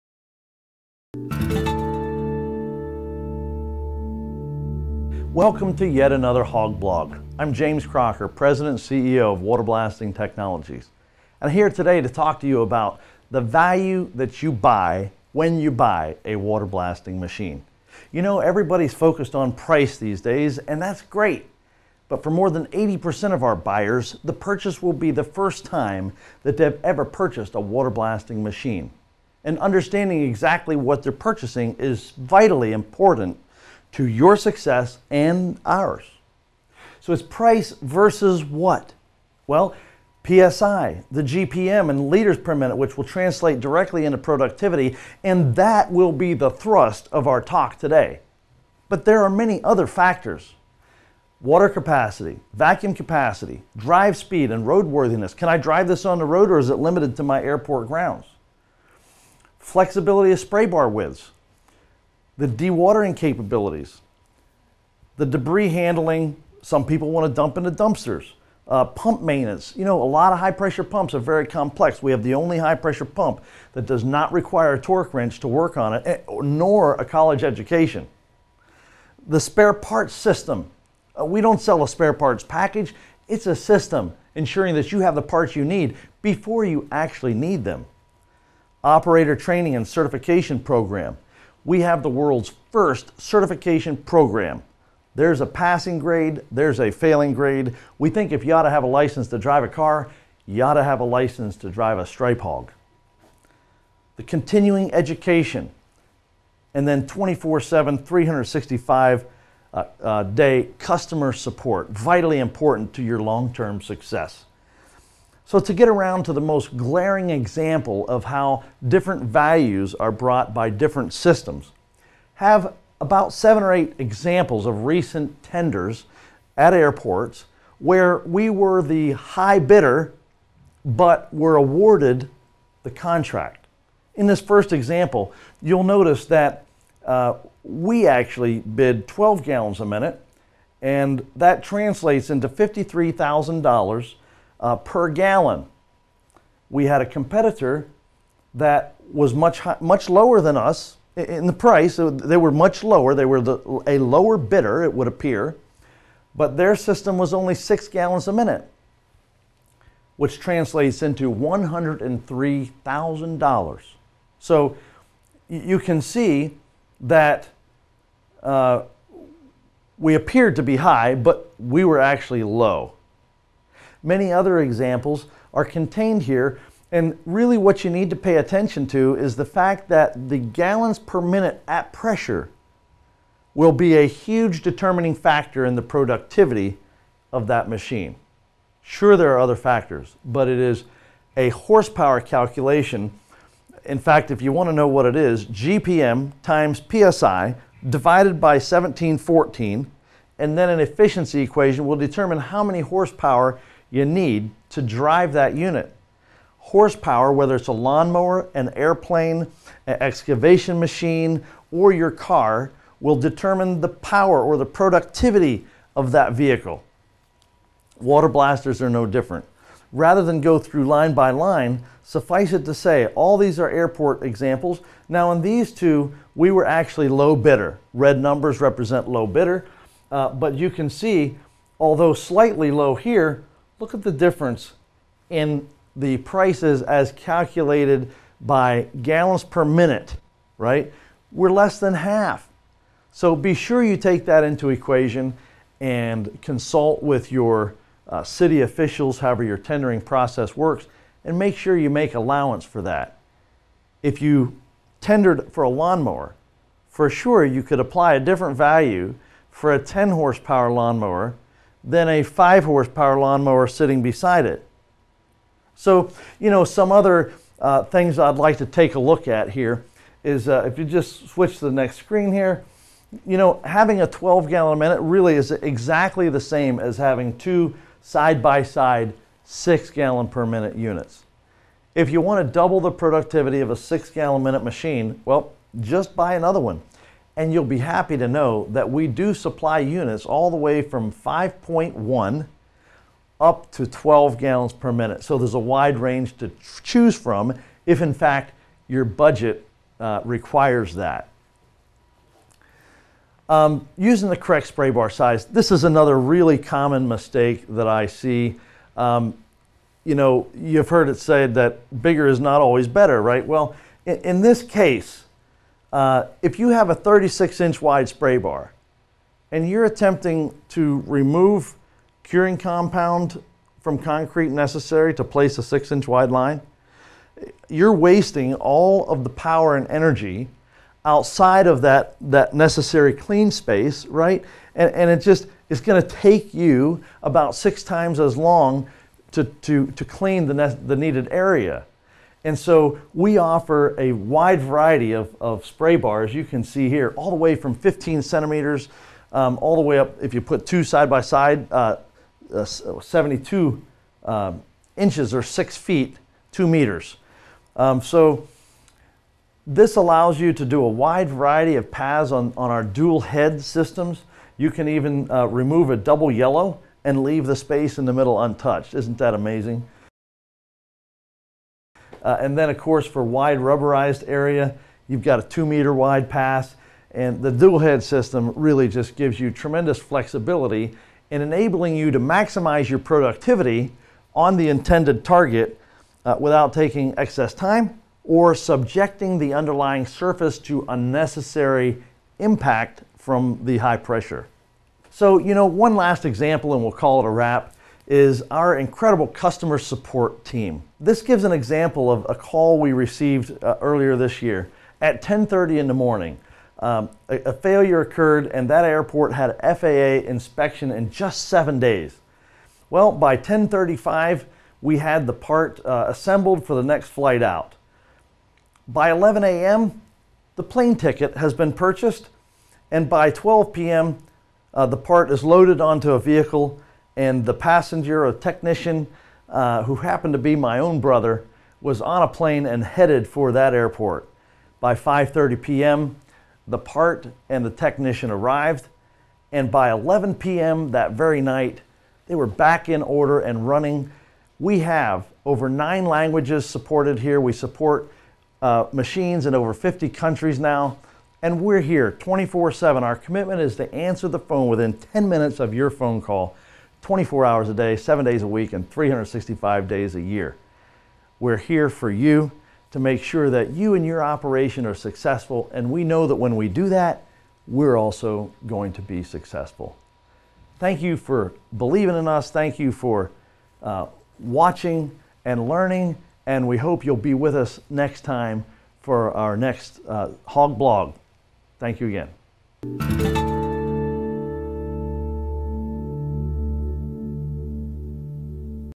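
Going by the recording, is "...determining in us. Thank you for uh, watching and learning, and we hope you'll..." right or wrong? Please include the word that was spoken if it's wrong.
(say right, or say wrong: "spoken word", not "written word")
wrong: "believing", not "determining".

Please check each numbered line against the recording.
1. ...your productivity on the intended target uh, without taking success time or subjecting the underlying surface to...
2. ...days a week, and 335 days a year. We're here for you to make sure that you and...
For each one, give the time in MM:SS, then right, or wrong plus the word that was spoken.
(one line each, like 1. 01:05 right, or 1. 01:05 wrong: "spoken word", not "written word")
1. 06:22 wrong: "excess", not "success"
2. 07:38 wrong: "365", not "335".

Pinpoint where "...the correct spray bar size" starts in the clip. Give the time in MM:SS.
05:04.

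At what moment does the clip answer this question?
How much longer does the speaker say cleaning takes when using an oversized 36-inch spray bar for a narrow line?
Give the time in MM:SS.
05:37.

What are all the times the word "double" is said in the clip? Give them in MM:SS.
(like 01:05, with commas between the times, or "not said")
04:42, 06:05.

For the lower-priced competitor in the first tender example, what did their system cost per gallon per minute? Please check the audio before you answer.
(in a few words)
$103,000.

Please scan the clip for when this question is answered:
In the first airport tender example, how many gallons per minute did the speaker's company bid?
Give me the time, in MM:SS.
02:19.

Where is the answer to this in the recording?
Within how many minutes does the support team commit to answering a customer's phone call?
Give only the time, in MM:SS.
07:34.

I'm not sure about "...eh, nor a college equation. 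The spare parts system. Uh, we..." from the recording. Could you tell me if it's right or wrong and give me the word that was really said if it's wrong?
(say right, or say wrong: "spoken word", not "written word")
wrong: "education", not "equation".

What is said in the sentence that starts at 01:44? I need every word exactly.
The continuing education, and then 24 7, 365 uh, uh, day customer support, vitally important to your long term success.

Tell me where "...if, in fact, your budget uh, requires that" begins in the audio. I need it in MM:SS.
04:57.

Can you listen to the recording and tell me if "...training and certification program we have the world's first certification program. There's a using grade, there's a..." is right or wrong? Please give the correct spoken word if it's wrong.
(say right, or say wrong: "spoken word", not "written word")
wrong: "passing", not "using".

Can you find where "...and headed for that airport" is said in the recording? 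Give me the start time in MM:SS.
07:12.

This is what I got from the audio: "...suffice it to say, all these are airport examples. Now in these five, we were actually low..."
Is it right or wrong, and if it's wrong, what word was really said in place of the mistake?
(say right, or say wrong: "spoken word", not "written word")
wrong: "two", not "five".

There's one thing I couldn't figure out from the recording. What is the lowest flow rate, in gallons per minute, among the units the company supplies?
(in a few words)
5.1.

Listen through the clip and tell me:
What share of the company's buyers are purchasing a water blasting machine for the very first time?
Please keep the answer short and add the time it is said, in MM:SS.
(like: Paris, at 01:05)
more than 80%, at 00:22.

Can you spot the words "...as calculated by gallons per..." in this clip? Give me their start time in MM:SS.
03:56.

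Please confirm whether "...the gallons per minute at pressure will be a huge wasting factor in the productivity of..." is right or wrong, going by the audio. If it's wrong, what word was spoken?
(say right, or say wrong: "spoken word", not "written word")
wrong: "determining", not "wasting".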